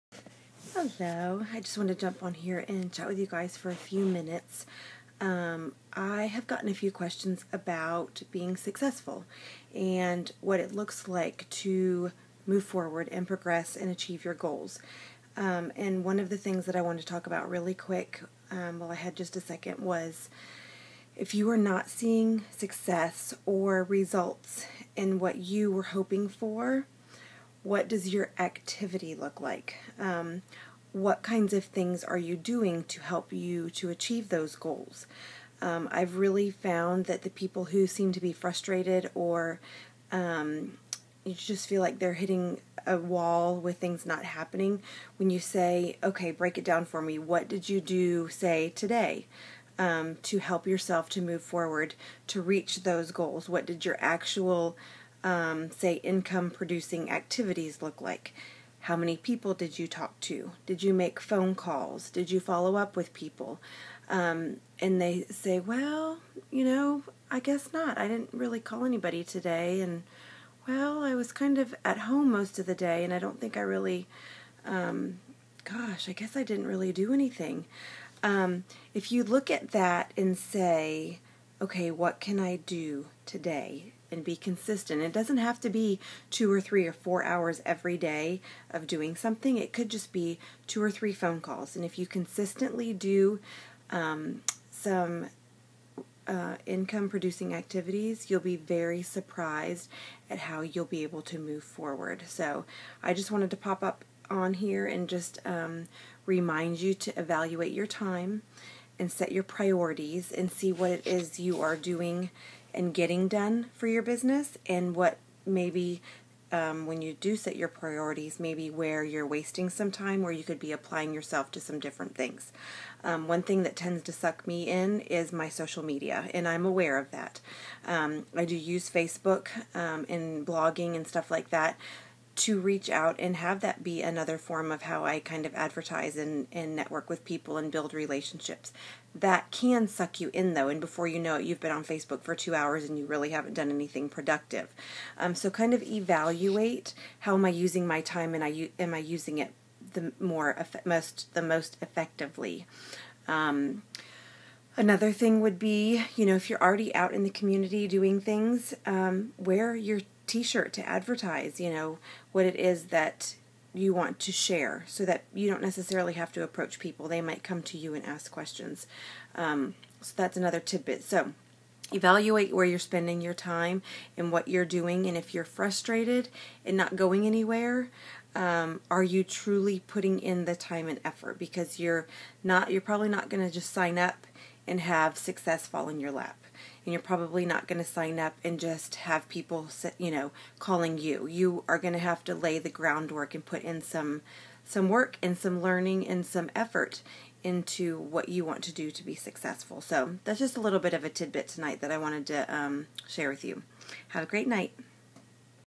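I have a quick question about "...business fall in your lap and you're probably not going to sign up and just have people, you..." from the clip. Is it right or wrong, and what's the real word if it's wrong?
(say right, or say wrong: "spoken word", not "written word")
wrong: "success", not "business".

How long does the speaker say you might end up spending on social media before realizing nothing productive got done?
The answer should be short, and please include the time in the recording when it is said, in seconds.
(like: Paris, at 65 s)
2 hours, at 142 s.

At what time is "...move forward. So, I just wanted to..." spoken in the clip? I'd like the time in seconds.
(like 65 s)
101 s.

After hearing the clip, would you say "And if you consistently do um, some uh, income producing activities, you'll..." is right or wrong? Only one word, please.
right.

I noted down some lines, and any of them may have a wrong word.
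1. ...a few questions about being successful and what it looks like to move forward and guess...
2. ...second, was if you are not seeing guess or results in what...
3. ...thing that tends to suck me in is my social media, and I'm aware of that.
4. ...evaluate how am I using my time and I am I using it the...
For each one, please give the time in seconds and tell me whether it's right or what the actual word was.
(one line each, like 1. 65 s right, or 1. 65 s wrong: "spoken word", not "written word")
1. 6 s wrong: "progress", not "guess"
2. 19 s wrong: "success", not "guess"
3. 123 s right
4. 145 s right.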